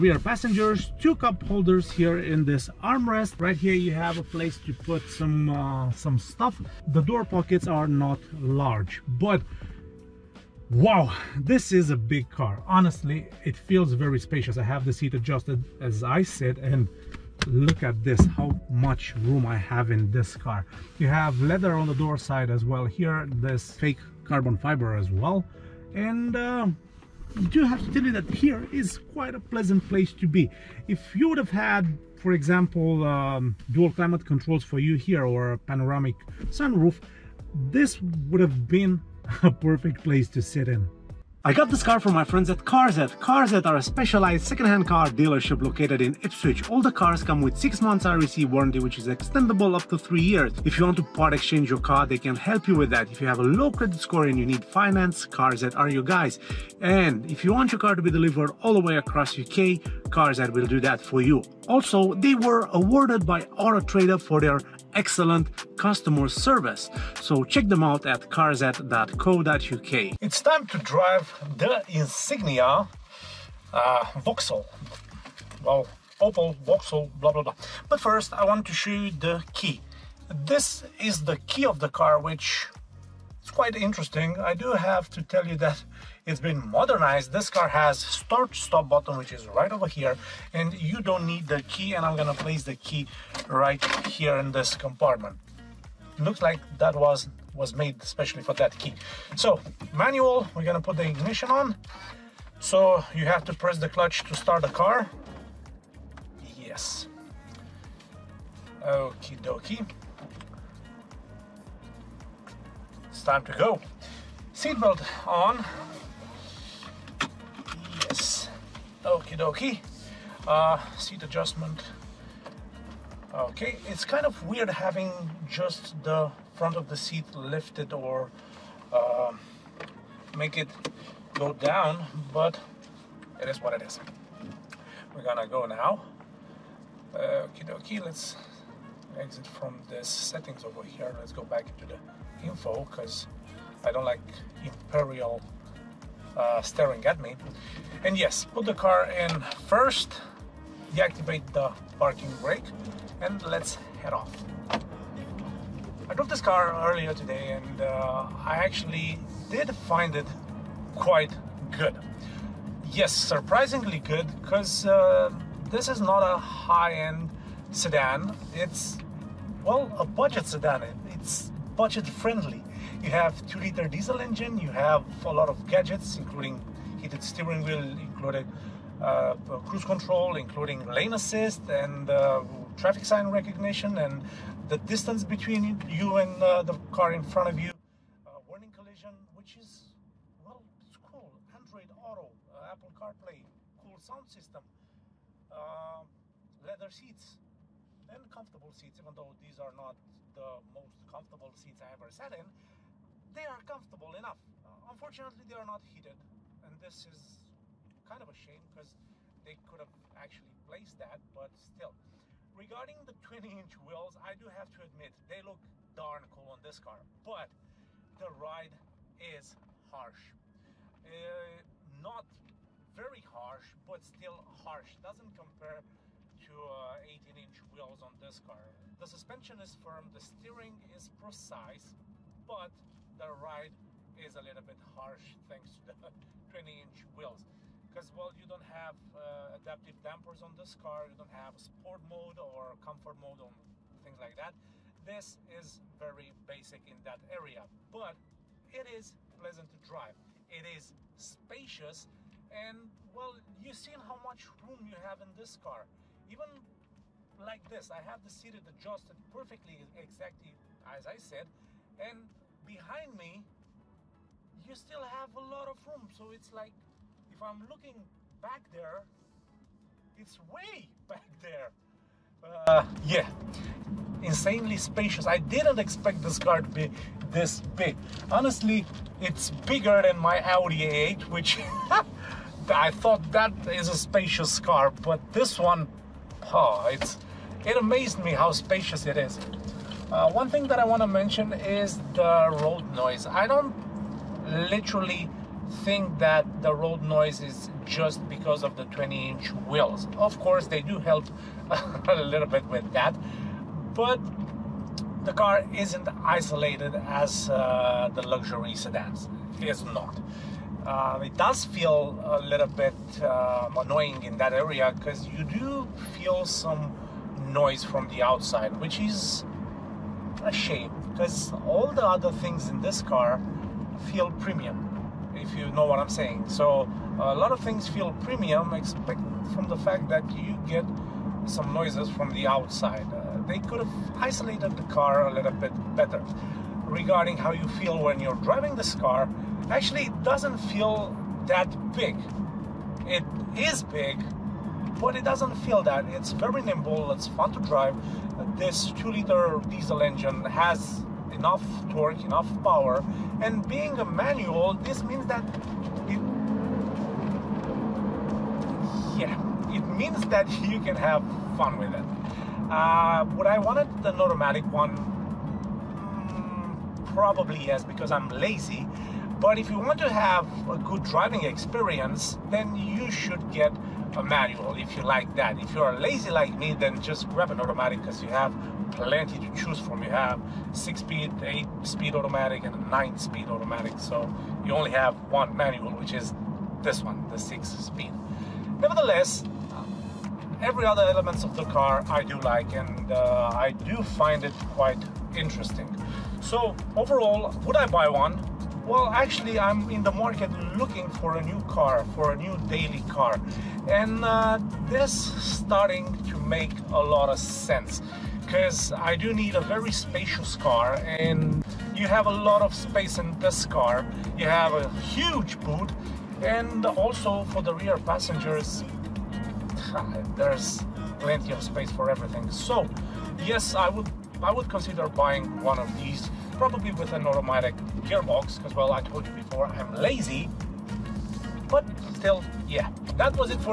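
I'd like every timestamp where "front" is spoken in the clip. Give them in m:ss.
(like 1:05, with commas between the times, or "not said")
2:06, 3:07.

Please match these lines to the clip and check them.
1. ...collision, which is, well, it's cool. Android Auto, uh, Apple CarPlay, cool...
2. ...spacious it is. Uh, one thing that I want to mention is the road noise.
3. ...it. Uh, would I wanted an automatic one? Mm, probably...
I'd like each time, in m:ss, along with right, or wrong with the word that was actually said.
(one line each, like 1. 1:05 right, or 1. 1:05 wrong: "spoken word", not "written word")
1. 3:08 right
2. 4:48 right
3. 6:01 right.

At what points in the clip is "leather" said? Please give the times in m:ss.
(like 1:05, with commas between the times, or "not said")
0:21, 3:16.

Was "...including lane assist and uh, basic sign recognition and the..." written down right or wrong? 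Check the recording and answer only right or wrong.
wrong.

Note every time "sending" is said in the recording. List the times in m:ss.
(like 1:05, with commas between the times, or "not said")
not said.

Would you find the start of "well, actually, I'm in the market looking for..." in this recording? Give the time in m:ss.
6:38.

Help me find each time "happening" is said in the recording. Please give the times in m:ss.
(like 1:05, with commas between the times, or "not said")
not said.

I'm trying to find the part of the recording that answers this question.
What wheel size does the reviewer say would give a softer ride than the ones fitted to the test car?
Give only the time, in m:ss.
3:47.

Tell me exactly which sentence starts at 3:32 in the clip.
Regarding the 20 inch wheels, I do have to admit they look darn cool on this car, but the ride is harsh.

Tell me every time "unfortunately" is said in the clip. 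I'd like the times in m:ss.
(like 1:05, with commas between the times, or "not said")
3:24.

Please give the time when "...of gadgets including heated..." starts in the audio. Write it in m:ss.
2:55.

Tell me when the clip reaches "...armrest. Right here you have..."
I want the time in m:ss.
0:02.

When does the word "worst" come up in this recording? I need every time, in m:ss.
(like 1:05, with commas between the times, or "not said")
not said.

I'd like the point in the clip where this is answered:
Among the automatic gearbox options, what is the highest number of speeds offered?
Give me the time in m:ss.
6:22.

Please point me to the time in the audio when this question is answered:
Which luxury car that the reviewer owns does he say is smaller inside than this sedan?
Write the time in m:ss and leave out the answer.
4:40.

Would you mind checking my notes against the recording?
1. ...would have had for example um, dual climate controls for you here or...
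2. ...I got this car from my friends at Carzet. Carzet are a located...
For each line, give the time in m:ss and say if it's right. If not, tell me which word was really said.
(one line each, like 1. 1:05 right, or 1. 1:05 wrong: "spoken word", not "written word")
1. 0:31 right
2. 0:41 wrong: "specialized", not "located".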